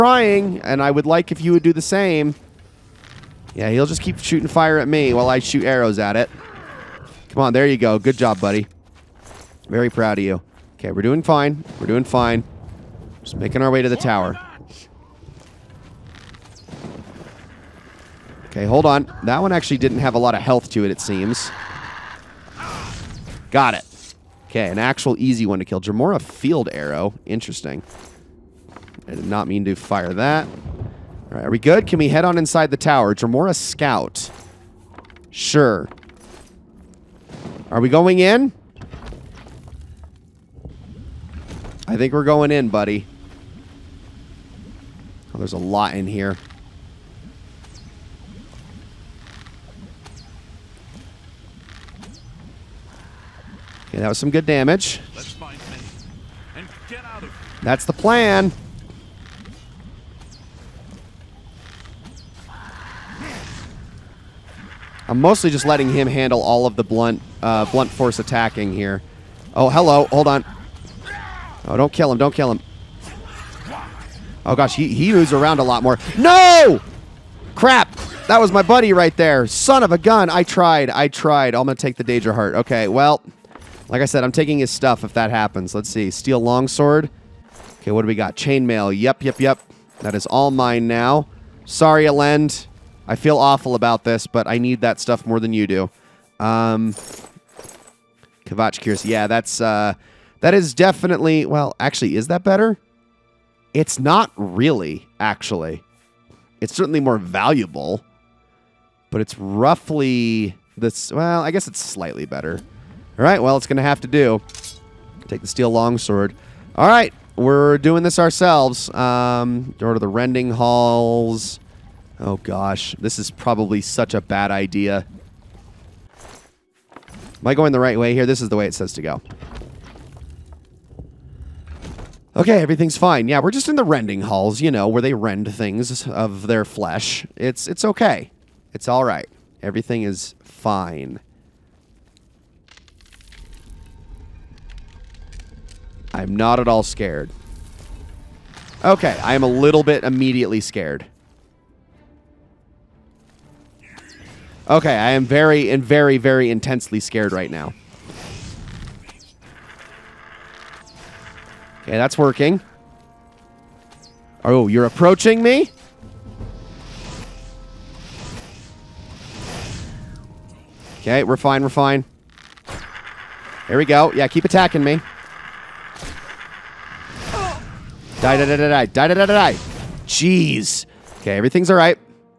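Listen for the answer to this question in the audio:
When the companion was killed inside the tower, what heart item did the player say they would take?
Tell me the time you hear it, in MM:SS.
01:22.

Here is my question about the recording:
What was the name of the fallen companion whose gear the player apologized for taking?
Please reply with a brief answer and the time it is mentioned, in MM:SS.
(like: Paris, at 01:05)
Ilend, at 01:32.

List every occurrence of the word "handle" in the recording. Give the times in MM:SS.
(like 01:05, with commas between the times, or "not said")
01:06.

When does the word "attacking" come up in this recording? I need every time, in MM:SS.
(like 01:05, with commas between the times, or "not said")
01:08, 02:54.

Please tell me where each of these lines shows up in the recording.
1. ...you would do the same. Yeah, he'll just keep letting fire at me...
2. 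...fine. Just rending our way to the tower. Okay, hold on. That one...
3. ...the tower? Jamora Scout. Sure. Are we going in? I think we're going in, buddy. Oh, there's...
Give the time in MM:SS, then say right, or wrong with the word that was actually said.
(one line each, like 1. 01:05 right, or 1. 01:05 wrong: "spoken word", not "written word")
1. 00:01 wrong: "shooting", not "letting"
2. 00:12 wrong: "making", not "rending"
3. 00:32 right.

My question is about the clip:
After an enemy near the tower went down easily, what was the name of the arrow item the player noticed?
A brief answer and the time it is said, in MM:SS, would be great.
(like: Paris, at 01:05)
Jamora Field Arrow, at 00:25.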